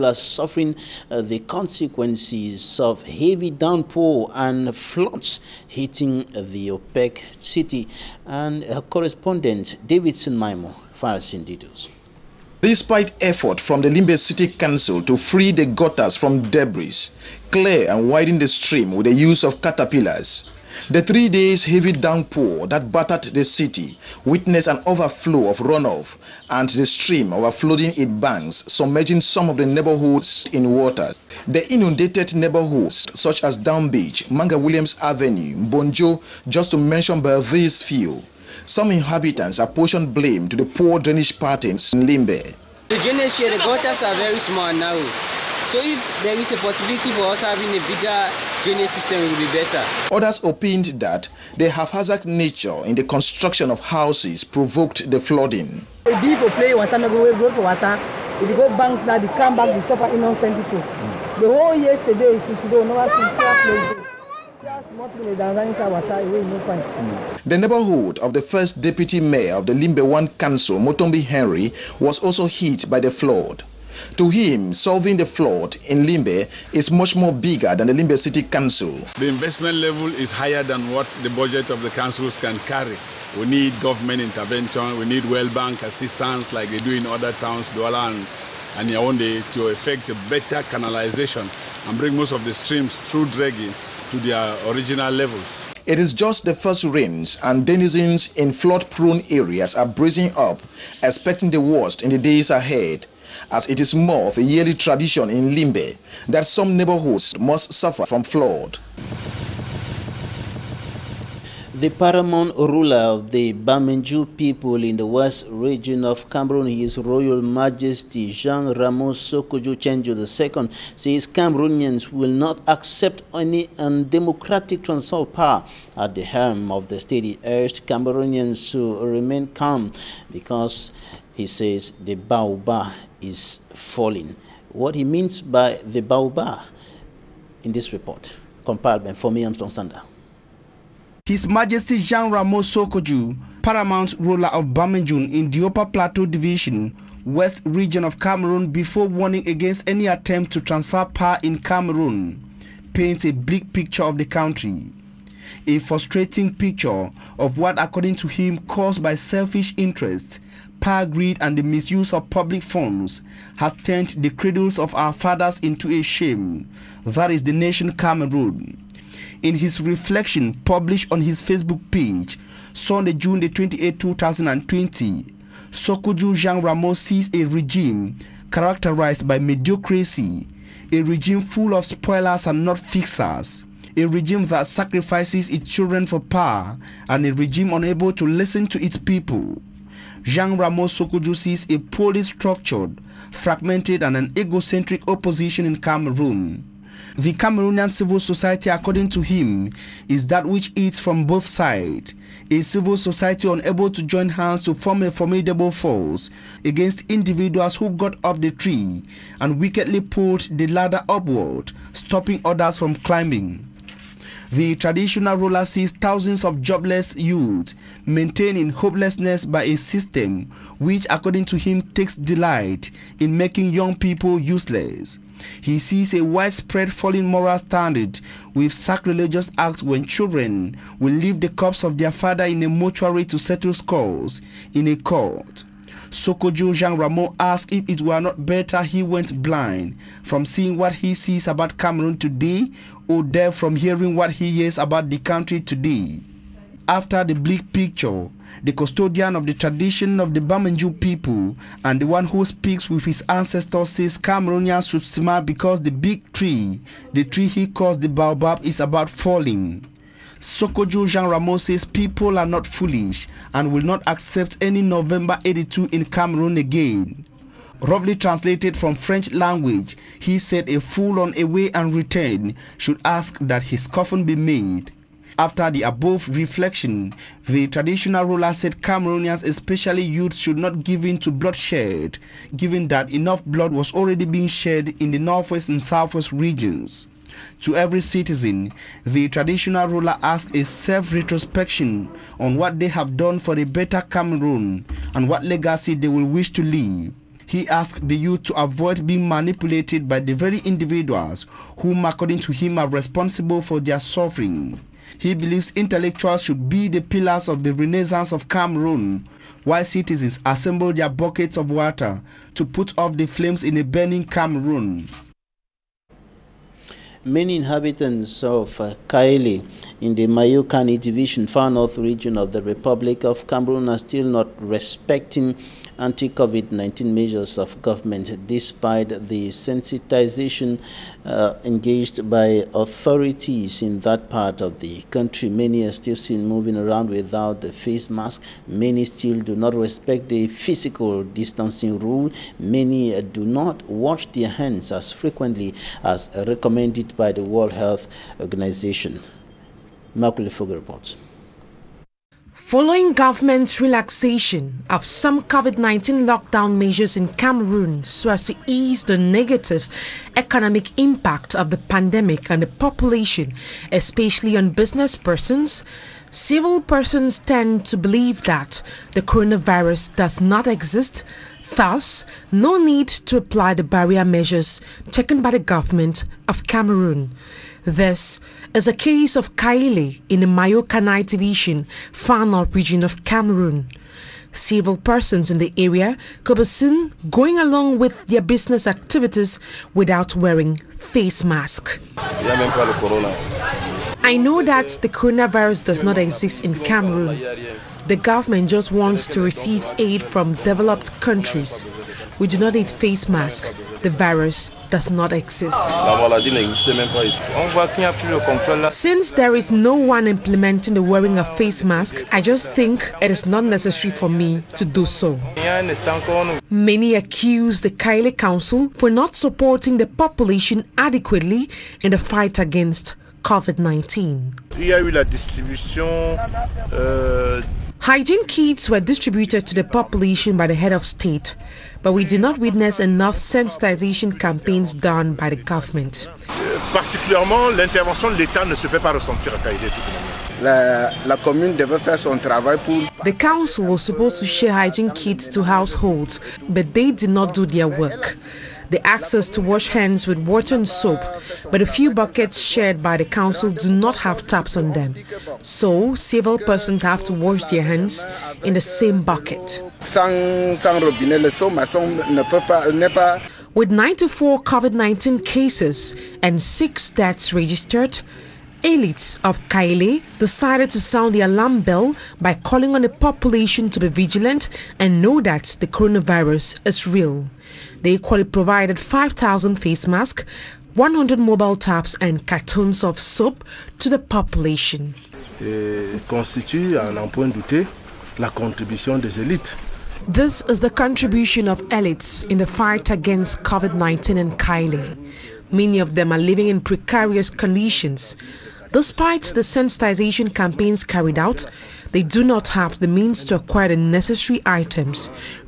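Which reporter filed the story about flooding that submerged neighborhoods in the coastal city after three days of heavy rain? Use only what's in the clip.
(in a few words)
Davidson Maimo.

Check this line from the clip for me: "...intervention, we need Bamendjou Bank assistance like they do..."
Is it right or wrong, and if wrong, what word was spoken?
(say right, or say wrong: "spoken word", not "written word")
wrong: "World", not "Bamendjou".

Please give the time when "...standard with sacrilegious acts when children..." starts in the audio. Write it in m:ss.
3:47.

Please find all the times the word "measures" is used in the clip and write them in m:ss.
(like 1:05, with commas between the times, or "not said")
5:27, 5:56, 6:14.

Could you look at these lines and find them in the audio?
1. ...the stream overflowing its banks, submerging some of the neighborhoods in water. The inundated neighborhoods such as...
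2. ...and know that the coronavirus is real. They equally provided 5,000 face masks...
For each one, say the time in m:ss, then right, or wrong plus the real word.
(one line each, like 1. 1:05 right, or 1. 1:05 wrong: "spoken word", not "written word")
1. 0:26 right
2. 7:54 right.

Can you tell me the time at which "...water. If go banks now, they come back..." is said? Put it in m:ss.
0:57.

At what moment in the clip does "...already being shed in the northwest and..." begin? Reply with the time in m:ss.
4:43.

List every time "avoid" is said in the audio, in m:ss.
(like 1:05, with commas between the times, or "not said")
4:58.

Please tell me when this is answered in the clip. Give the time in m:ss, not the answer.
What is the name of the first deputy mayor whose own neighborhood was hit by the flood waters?
1:10.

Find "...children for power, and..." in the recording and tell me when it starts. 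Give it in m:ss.
3:05.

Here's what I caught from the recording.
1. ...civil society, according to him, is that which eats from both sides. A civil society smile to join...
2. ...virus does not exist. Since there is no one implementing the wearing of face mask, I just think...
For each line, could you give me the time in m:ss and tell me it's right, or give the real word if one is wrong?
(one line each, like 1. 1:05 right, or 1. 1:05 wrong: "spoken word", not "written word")
1. 3:17 wrong: "unable", not "smile"
2. 6:44 right.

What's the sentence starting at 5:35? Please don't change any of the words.
Many are still seen moving around without the face mask.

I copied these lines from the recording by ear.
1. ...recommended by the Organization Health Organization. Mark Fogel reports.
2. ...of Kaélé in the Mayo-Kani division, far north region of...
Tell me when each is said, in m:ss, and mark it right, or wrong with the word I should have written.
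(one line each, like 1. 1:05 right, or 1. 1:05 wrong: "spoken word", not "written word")
1. 5:46 wrong: "World", not "Organization"
2. 6:19 right.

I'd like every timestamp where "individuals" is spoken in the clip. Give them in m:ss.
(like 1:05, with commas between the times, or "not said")
3:27, 5:00.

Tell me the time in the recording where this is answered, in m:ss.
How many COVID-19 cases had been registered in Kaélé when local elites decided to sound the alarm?
7:43.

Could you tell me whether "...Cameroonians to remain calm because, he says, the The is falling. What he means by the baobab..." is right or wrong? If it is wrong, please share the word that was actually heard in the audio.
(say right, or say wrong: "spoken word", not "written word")
wrong: "Baoba", not "The".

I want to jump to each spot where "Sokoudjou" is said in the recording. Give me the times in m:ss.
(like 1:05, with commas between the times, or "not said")
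1:59, 2:22, 2:55, 3:10, 3:56, 4:20.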